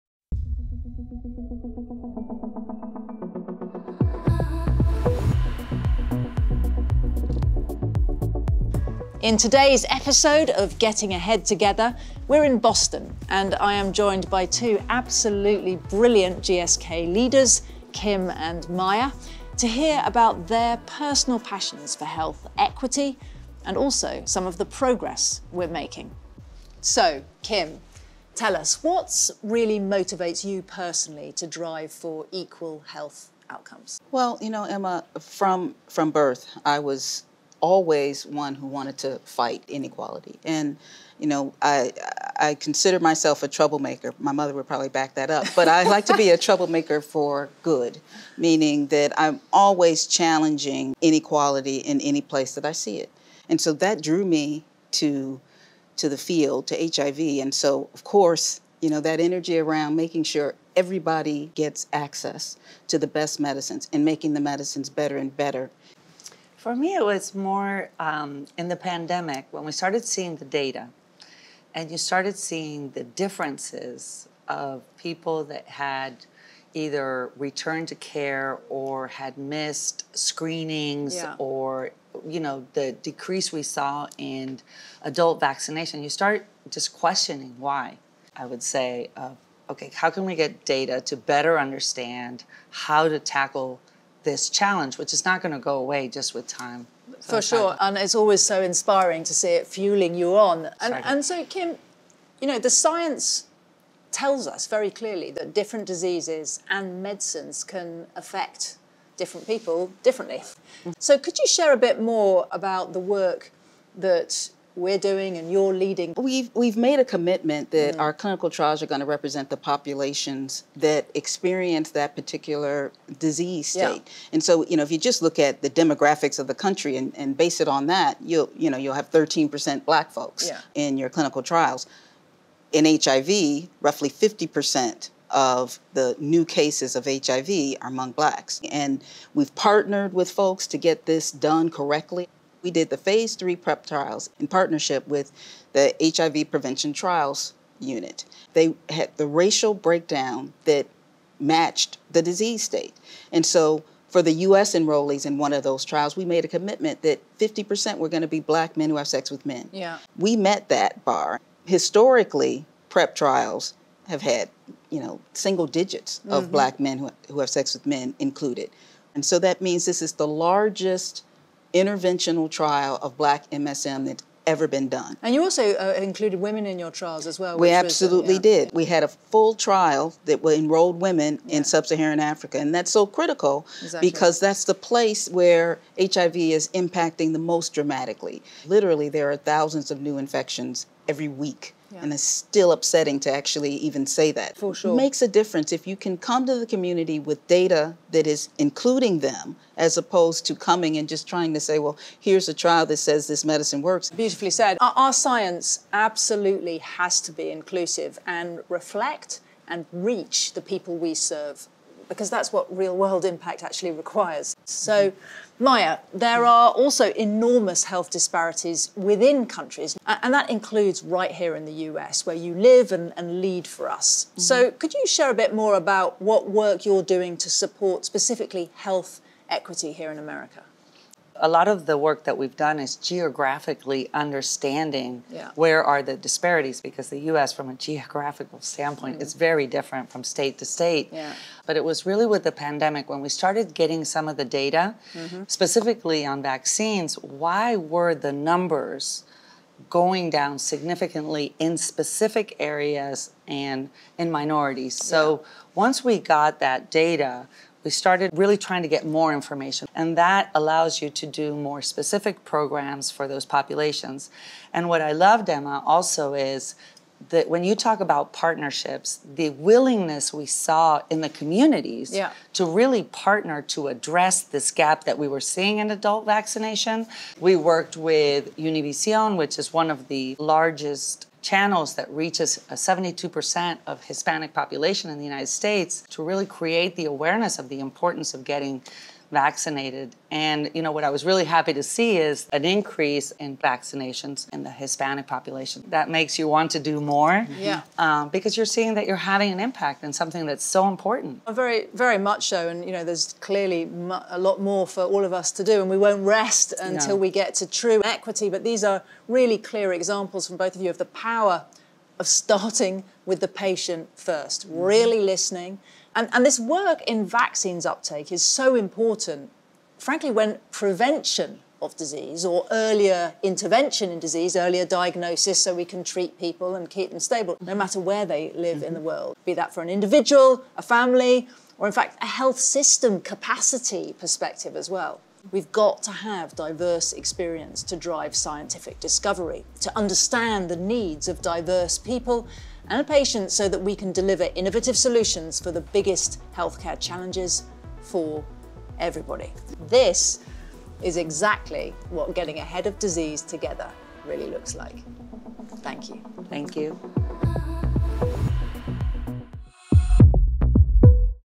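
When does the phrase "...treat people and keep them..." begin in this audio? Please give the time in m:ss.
5:26.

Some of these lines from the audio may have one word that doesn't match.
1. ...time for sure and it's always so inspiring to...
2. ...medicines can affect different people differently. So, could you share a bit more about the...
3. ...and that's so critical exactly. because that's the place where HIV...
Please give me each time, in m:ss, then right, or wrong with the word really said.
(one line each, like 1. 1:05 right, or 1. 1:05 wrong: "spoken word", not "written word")
1. 1:36 right
2. 1:47 right
3. 3:02 right.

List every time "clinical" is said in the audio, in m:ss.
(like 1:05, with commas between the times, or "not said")
1:58, 2:11.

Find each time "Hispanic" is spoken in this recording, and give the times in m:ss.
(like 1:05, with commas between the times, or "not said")
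4:44, 4:54.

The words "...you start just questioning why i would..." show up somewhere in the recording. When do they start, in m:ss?
1:26.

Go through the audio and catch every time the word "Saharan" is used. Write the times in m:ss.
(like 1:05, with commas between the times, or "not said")
3:01.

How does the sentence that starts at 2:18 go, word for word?
And we've partnered with folks to get this done correctly.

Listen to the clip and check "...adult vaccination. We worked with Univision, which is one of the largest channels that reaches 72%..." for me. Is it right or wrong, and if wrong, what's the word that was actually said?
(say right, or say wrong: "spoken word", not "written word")
right.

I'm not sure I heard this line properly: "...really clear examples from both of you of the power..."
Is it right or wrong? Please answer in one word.
right.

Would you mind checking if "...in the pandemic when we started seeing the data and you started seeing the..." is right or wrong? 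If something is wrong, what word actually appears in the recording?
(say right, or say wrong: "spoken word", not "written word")
right.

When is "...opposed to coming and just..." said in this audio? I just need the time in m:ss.
3:19.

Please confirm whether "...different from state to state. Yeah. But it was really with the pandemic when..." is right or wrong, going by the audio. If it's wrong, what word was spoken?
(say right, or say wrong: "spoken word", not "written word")
right.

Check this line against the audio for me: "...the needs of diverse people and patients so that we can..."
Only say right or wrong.
right.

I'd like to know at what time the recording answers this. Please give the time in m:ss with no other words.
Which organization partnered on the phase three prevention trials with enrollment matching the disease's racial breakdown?
2:26.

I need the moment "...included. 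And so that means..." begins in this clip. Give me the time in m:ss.
2:48.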